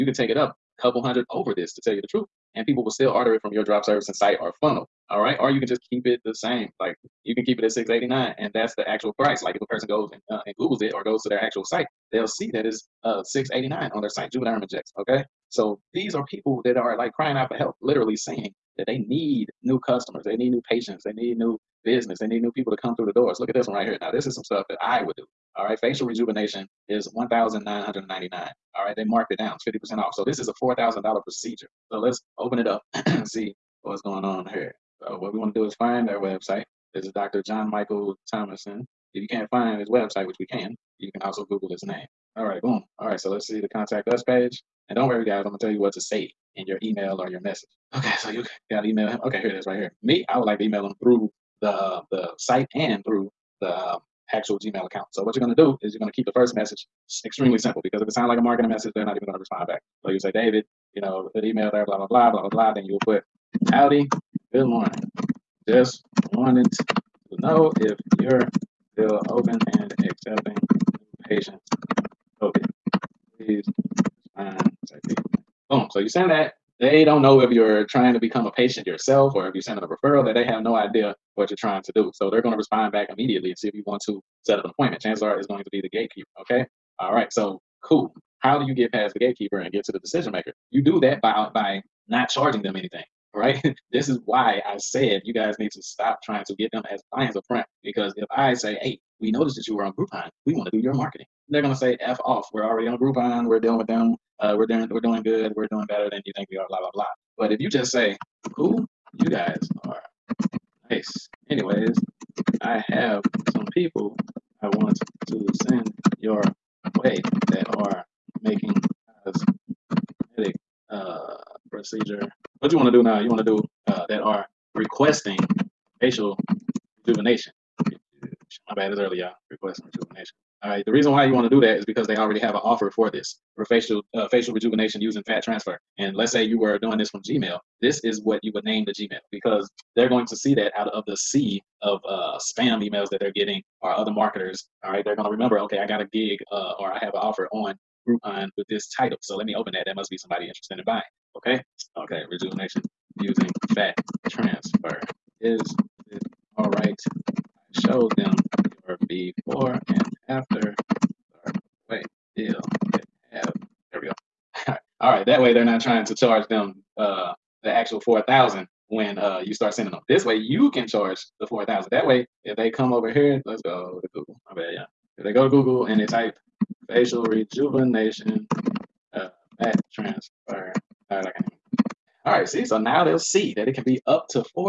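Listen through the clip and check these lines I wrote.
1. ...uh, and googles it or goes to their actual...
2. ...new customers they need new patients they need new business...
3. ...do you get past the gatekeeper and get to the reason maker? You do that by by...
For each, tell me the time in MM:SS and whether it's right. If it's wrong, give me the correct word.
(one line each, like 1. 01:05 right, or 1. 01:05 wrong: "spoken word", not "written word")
1. 00:10 right
2. 00:19 right
3. 01:28 wrong: "decision", not "reason".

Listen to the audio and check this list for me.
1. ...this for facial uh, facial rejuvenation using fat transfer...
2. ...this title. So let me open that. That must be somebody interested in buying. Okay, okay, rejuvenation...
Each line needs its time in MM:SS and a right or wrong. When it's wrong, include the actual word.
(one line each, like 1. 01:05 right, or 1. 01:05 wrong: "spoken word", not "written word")
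1. 02:13 right
2. 02:28 right.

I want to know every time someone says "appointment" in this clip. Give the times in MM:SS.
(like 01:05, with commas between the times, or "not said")
01:24.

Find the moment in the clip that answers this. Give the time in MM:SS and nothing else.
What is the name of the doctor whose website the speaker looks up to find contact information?
00:37.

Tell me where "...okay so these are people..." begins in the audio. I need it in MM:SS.
00:14.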